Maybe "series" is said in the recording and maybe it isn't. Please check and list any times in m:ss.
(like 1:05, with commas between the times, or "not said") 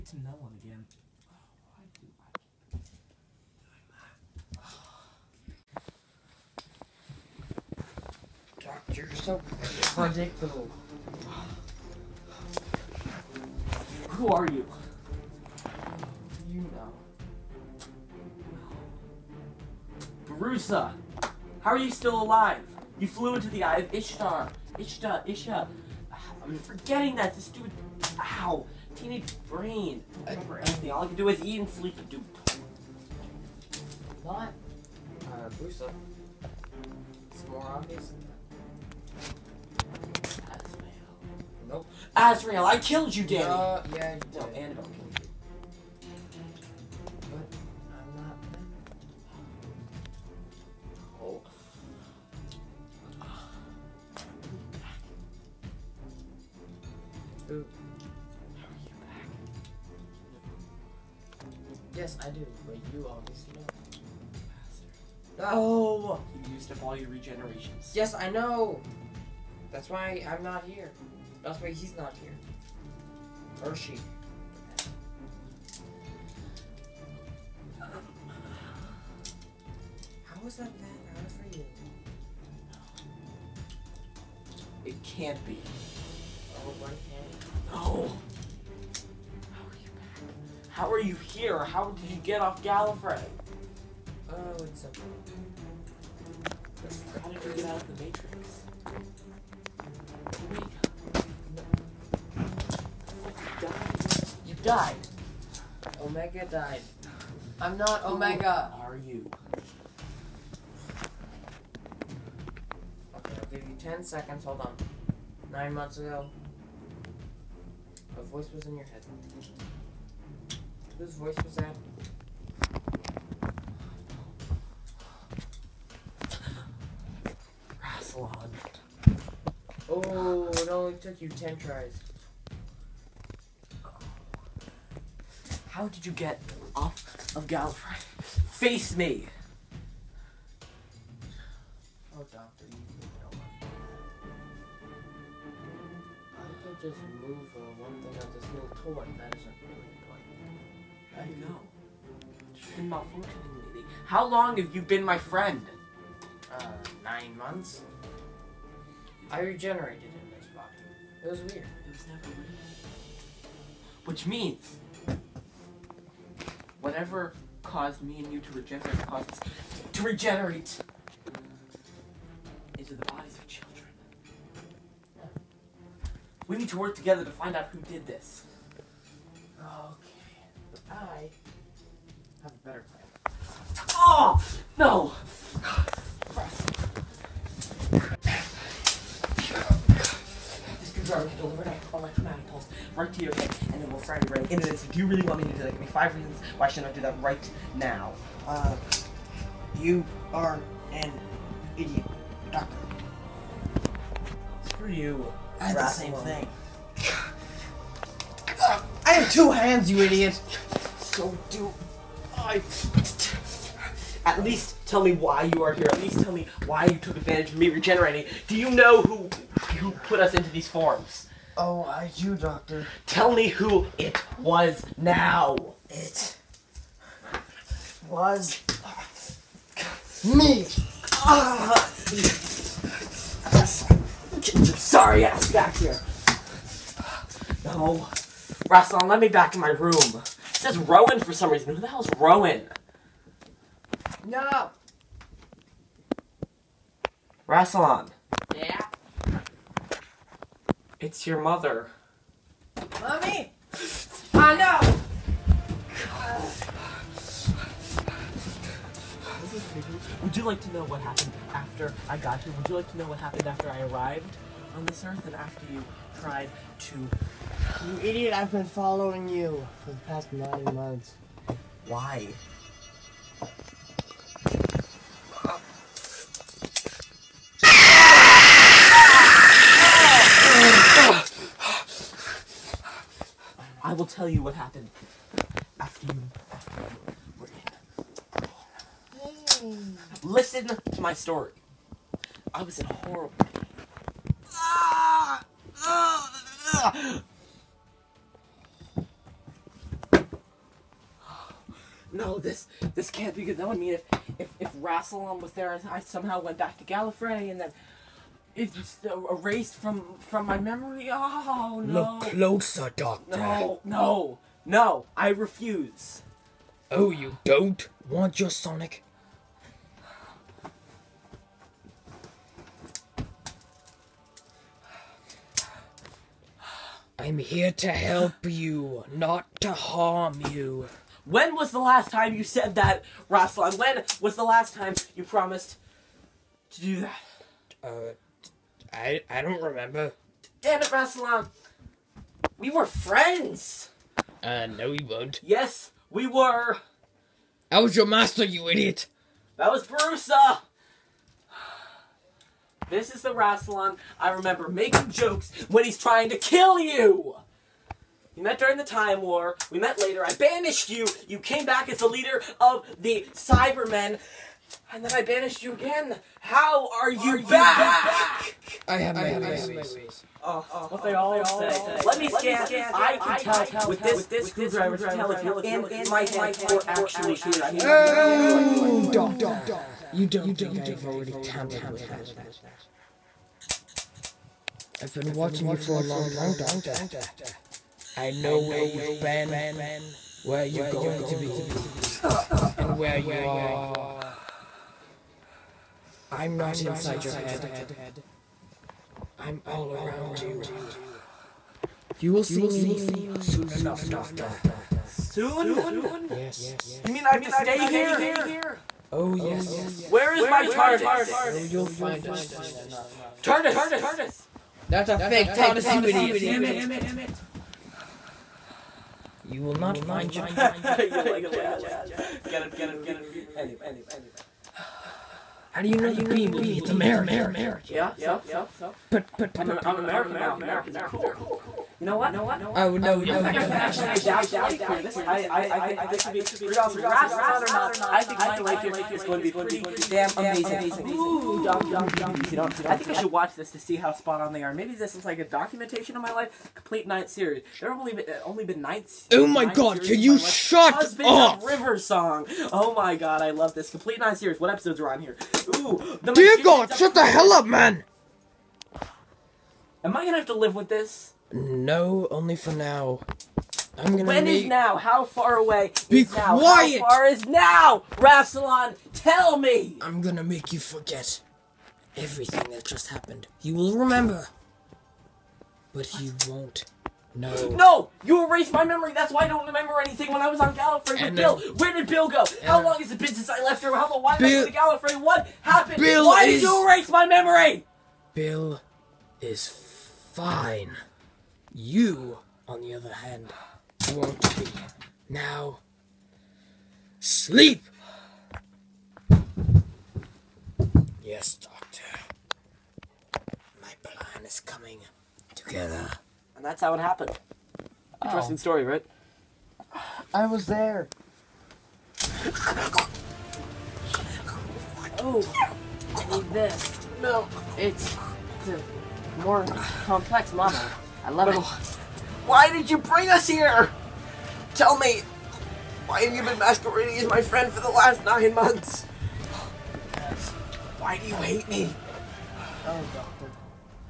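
7:27, 7:34.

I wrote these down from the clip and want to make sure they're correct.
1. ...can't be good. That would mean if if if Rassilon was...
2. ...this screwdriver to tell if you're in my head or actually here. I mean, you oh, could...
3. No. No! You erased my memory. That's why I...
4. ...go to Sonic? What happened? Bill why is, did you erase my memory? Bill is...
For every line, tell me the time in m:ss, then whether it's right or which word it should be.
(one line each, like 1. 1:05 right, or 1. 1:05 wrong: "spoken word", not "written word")
1. 5:03 right
2. 6:14 right
3. 7:57 right
4. 8:04 wrong: "Gallifrey", not "Sonic".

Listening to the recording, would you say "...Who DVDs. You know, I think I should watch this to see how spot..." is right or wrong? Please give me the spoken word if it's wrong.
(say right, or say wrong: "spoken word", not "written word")
right.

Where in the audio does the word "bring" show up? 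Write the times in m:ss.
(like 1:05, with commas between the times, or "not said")
8:42.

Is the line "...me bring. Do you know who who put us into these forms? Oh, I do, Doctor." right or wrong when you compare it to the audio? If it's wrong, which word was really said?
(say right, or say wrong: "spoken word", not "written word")
wrong: "regenerating", not "bring".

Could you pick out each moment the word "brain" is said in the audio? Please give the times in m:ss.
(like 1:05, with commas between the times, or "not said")
0:29.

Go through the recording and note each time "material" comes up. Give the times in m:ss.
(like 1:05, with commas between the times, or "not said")
not said.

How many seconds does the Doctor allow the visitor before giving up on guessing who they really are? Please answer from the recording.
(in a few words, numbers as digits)
10.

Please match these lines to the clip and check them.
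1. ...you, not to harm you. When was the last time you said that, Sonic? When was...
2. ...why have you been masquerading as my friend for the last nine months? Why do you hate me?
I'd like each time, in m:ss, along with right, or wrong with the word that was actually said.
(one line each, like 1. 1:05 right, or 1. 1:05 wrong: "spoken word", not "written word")
1. 5:28 wrong: "Rassilon", not "Sonic"
2. 8:46 right.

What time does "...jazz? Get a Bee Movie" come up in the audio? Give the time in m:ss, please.
7:01.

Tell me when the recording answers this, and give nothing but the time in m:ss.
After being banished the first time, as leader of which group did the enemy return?
6:02.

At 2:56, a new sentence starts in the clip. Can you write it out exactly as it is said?
We need to work together to find out who did this.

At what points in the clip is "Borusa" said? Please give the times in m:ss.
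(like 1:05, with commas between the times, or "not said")
0:20, 5:49.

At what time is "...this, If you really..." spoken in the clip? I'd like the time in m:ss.
3:14.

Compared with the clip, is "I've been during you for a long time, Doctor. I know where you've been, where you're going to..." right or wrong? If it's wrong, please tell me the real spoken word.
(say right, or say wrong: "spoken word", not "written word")
wrong: "watching", not "during".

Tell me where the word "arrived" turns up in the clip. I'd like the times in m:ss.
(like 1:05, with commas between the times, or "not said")
4:23.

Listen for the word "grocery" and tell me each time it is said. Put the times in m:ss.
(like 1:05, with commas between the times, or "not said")
not said.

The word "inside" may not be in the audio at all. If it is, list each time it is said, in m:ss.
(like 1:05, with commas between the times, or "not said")
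6:36.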